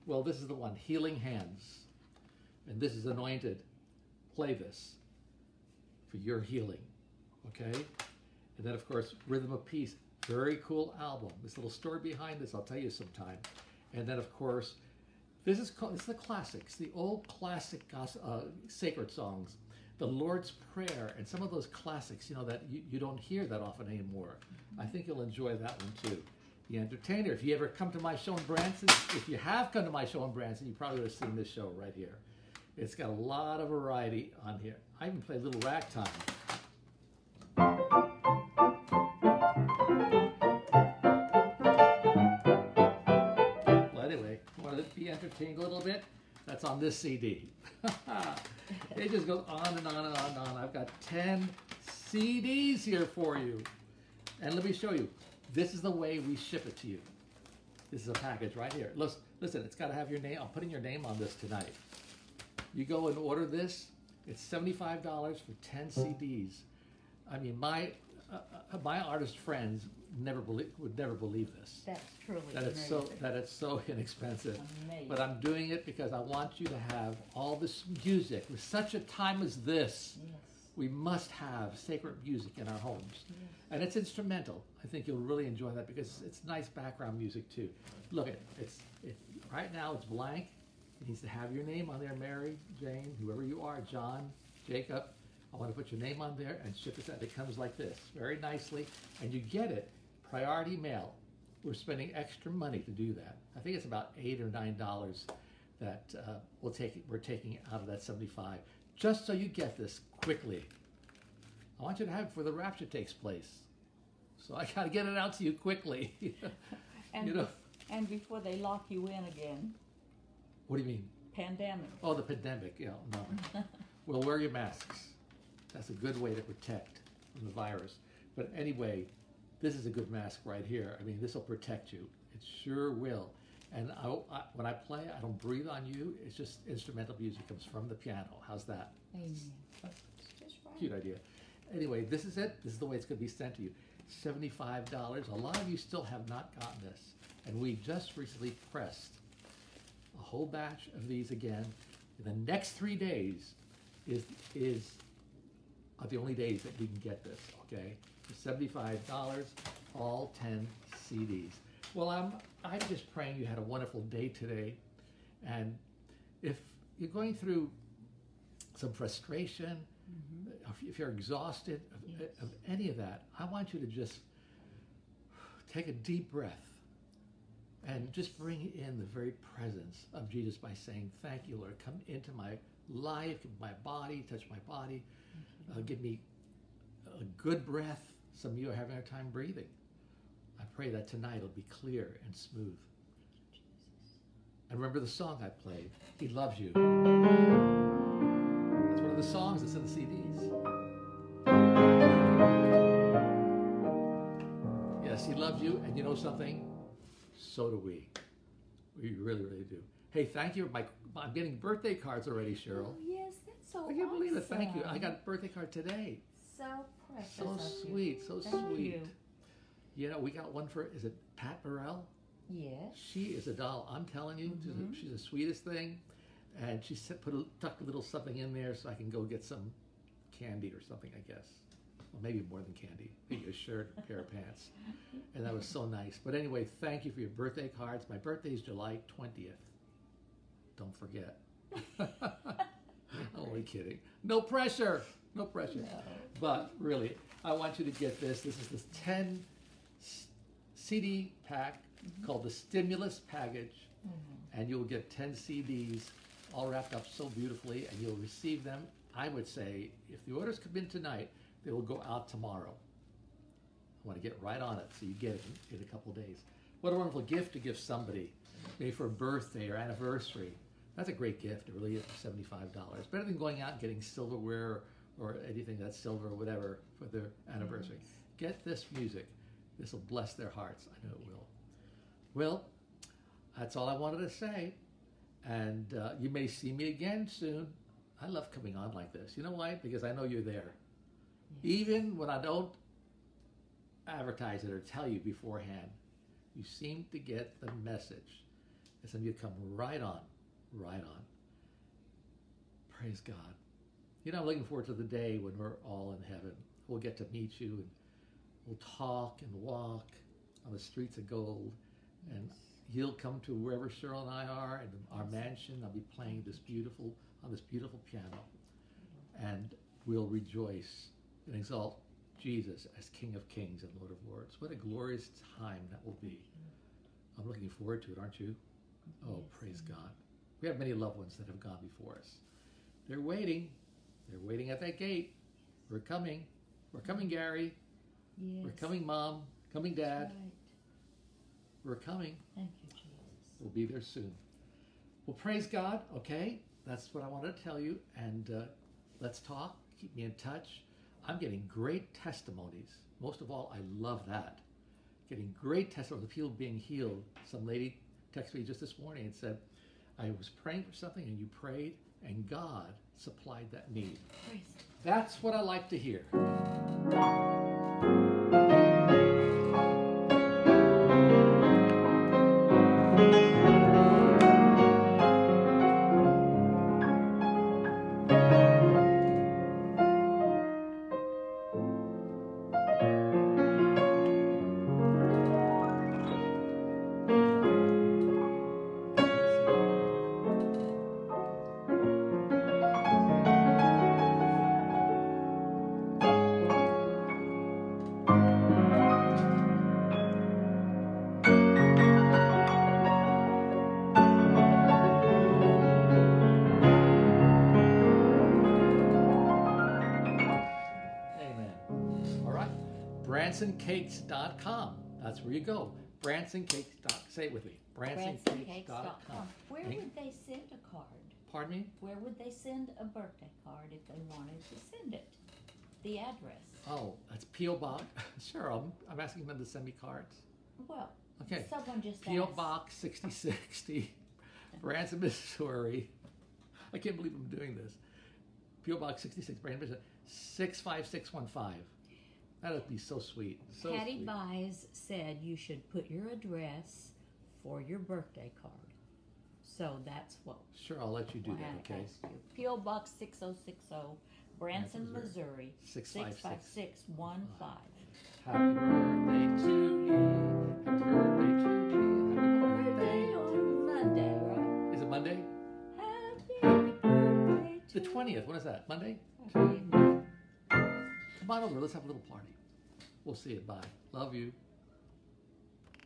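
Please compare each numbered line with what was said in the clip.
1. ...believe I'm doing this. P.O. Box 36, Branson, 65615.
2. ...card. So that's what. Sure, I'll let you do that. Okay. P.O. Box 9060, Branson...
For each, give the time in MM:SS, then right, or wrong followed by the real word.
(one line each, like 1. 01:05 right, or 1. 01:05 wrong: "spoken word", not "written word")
1. 07:17 wrong: "66", not "36"
2. 07:28 wrong: "6060", not "9060".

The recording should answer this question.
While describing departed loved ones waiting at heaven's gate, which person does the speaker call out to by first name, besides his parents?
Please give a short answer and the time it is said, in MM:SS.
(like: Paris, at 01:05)
Gary, at 05:37.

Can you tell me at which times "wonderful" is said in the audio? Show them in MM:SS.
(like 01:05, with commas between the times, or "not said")
02:43, 04:26.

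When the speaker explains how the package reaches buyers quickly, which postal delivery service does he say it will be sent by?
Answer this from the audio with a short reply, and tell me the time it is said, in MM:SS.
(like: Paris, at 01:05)
Priority mail, at 01:40.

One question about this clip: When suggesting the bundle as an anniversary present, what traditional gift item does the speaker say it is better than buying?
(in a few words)
Silverware.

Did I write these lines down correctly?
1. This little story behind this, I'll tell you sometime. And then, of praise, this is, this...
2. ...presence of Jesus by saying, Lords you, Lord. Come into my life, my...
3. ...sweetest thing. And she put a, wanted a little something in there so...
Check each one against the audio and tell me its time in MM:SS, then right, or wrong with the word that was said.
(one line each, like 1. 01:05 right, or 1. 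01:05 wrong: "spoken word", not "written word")
1. 00:11 wrong: "course", not "praise"
2. 02:59 wrong: "Thank", not "Lords"
3. 03:45 wrong: "tucked", not "wanted".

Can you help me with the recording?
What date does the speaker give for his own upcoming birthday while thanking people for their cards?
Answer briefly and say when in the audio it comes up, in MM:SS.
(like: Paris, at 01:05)
July 20th, at 03:58.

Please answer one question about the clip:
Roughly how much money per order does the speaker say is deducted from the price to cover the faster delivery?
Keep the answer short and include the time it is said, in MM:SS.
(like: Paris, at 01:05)
8 or 9 dollars, at 01:44.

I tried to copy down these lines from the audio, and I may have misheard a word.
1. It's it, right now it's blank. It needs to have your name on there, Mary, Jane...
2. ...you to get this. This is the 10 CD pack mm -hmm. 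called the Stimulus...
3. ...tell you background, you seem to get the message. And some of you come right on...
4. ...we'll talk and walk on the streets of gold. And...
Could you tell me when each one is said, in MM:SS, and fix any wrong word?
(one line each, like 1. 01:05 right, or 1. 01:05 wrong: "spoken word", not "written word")
1. 01:28 right
2. 04:07 right
3. 04:54 wrong: "beforehand", not "background"
4. 05:08 right.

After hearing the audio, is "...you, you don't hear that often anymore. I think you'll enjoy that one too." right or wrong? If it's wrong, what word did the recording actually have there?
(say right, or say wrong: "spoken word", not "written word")
right.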